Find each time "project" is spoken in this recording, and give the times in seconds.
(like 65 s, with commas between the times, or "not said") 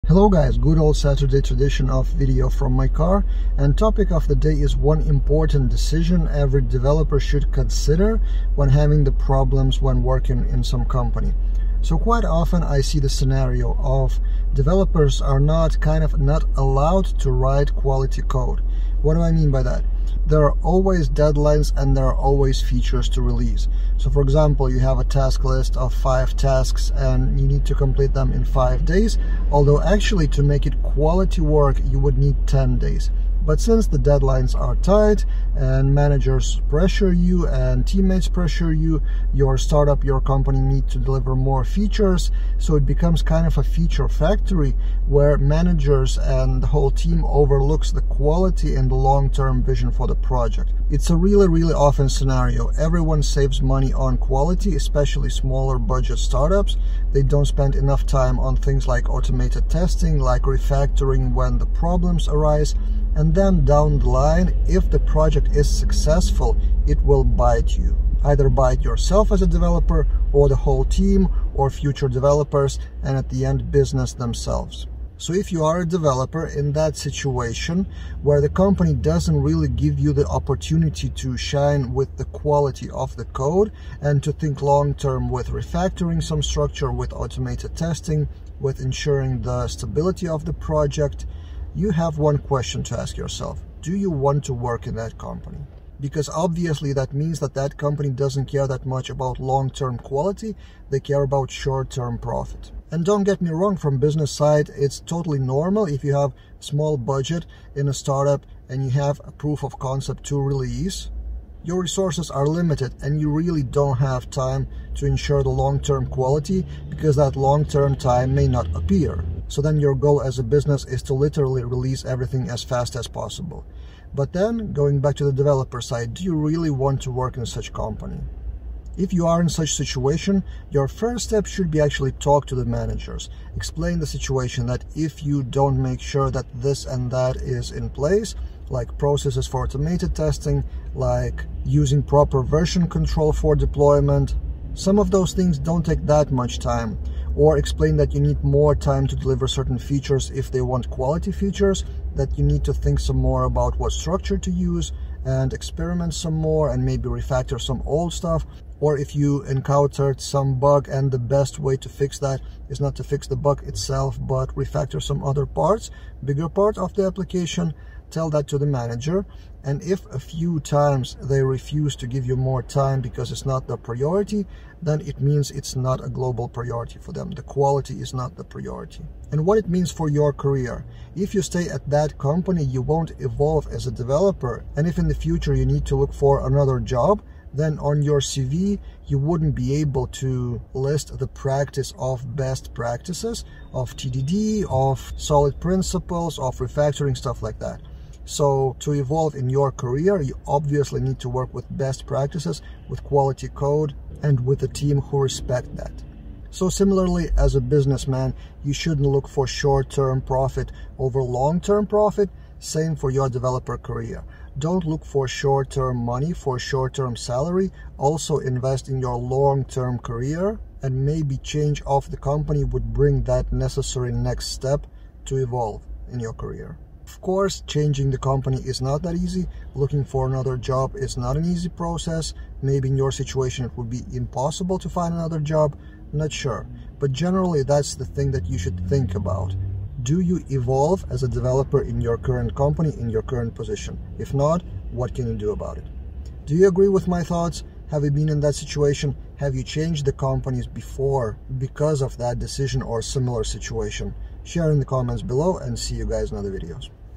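50 s, 64 s, 90 s.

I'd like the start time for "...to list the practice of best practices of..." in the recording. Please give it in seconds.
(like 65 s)
190 s.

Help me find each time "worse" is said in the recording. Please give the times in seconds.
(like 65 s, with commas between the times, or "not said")
not said.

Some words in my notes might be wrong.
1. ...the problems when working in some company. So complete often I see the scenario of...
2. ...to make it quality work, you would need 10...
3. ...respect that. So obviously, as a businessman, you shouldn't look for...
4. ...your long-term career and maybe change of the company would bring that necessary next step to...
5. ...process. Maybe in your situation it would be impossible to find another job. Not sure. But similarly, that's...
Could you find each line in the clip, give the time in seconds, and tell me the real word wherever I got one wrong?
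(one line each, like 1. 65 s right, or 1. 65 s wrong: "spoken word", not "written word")
1. 9 s wrong: "quite", not "complete"
2. 30 s right
3. 205 s wrong: "similarly", not "obviously"
4. 219 s right
5. 231 s wrong: "generally", not "similarly".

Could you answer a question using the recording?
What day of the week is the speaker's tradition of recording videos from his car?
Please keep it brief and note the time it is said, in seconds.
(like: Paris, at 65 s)
Saturday, at 0 s.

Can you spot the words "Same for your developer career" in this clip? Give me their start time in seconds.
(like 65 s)
212 s.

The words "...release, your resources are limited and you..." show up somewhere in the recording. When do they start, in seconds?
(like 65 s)
110 s.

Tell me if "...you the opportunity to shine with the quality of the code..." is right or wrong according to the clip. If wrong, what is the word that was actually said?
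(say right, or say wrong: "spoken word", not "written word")
right.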